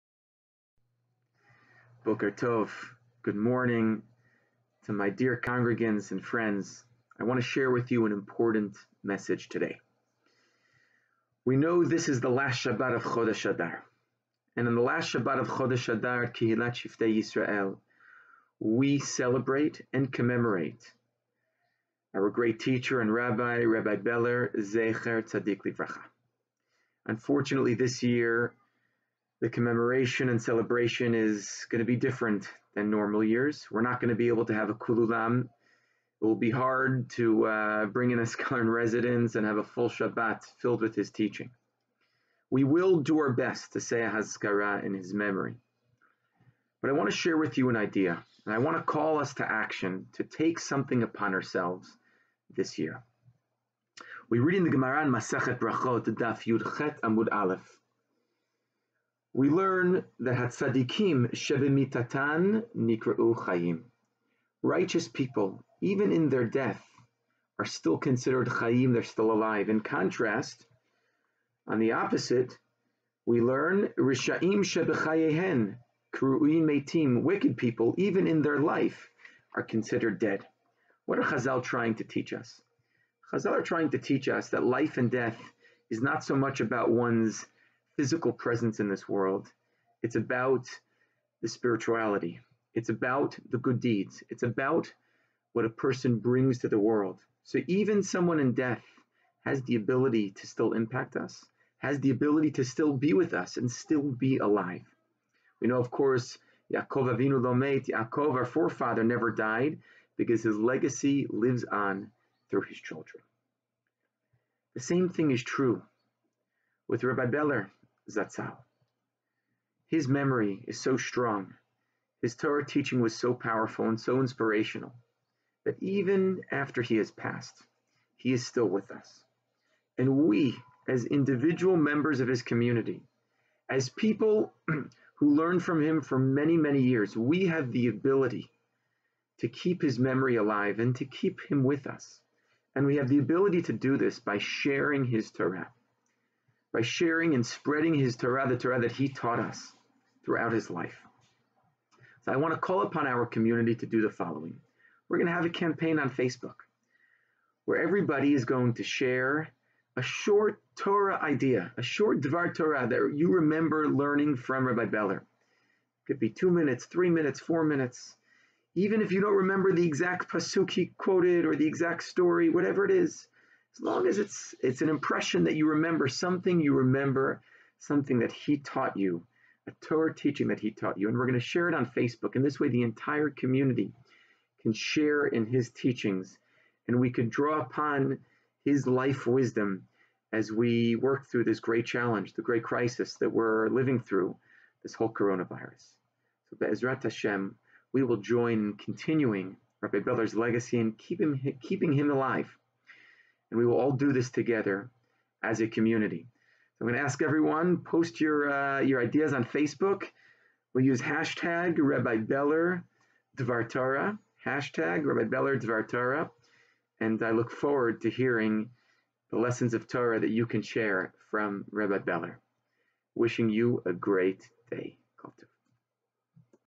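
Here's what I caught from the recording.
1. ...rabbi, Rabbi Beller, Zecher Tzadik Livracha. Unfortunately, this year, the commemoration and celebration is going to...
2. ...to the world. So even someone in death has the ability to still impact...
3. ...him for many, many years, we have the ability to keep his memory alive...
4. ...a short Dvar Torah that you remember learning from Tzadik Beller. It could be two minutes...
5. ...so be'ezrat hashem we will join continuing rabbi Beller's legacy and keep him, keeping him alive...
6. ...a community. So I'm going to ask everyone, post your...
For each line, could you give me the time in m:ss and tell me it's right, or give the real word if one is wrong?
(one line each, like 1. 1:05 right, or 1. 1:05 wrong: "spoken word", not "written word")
1. 0:23 right
2. 1:36 right
3. 2:15 right
4. 2:41 wrong: "Rabbi", not "Tzadik"
5. 3:16 right
6. 3:25 right.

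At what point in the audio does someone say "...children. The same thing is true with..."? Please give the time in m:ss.
1:52.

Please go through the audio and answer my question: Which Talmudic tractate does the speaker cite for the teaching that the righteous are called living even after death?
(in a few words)
Brachot.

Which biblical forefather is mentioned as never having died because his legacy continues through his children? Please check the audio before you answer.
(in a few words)
Yaakov Avinu.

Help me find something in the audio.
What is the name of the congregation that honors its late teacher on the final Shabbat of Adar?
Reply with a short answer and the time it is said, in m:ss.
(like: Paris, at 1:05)
Kihilat Shiftei Yisrael, at 0:16.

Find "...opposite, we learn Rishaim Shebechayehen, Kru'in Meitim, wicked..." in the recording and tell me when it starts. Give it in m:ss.
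1:11.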